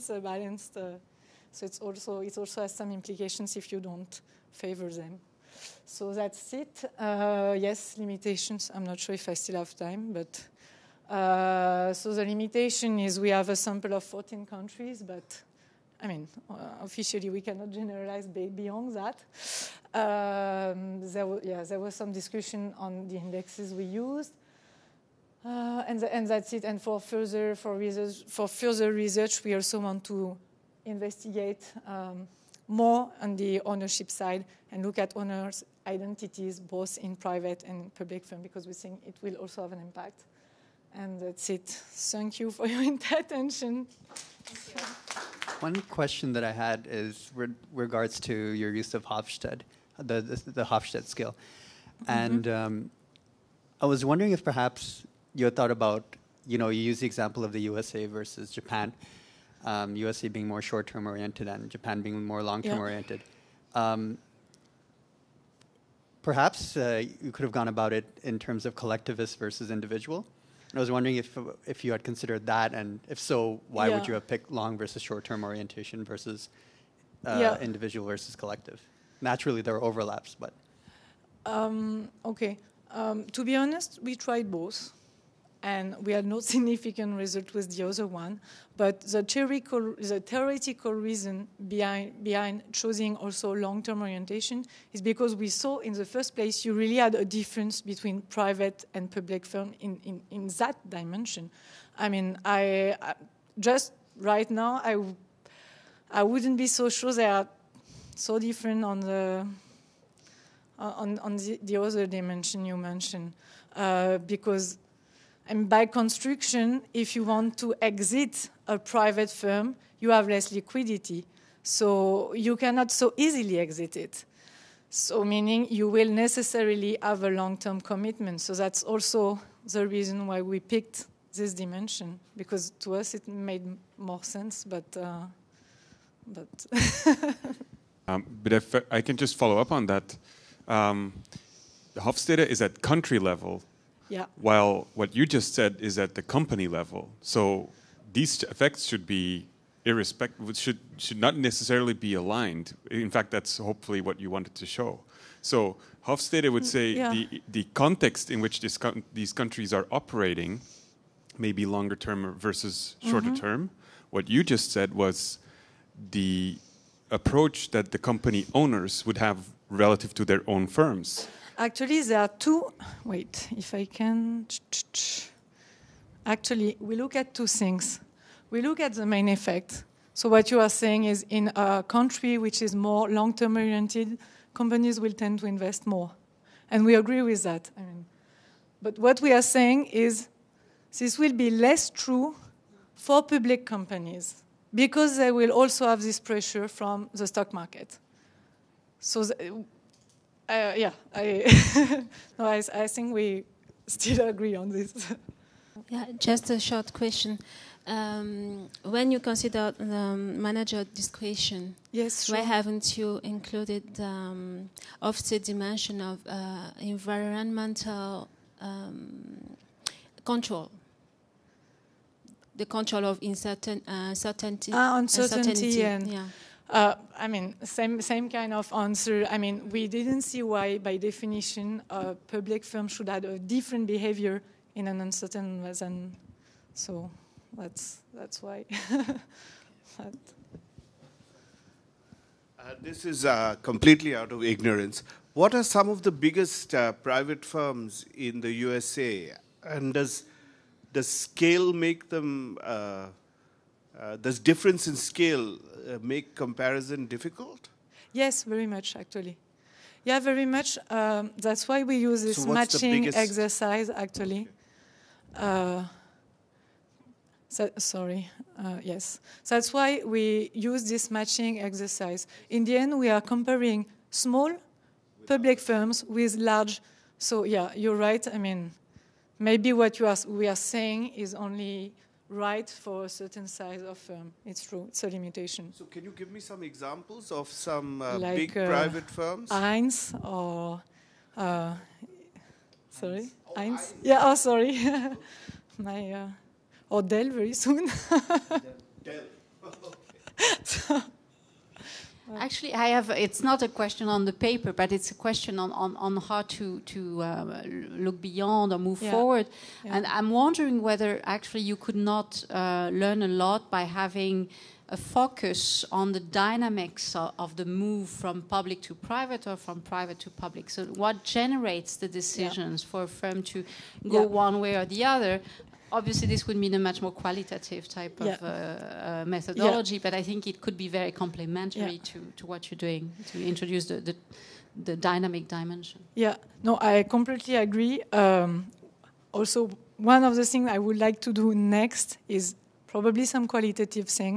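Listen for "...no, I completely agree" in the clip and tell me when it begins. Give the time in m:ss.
5:36.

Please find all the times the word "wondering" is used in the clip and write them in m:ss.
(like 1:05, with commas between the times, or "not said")
0:54, 1:10, 5:10.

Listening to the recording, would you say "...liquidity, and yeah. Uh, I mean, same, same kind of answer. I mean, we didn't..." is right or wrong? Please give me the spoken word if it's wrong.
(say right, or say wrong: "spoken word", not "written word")
wrong: "uncertainty", not "liquidity".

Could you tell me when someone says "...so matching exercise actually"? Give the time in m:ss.
4:22.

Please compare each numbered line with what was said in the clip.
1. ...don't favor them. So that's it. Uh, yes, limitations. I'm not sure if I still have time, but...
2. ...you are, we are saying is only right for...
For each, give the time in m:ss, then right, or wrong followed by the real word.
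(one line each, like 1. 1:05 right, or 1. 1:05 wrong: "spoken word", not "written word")
1. 0:03 right
2. 4:39 right.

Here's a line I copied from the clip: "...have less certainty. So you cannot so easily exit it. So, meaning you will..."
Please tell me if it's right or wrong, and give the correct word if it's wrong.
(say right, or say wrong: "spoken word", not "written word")
wrong: "liquidity", not "certainty".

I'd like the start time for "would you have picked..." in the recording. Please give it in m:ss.
1:13.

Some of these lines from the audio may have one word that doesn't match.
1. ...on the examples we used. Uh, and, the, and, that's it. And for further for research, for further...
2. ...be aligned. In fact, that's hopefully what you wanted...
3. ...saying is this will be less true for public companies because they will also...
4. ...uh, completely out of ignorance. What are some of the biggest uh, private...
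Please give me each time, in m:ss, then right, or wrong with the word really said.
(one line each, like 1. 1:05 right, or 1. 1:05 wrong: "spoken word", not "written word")
1. 0:22 wrong: "indexes", not "examples"
2. 2:31 right
3. 3:09 right
4. 4:03 right.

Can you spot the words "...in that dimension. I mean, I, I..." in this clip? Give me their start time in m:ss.
1:40.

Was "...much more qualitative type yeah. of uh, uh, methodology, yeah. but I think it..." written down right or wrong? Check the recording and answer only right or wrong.
right.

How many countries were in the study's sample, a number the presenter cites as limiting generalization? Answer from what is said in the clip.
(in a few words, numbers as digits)
14.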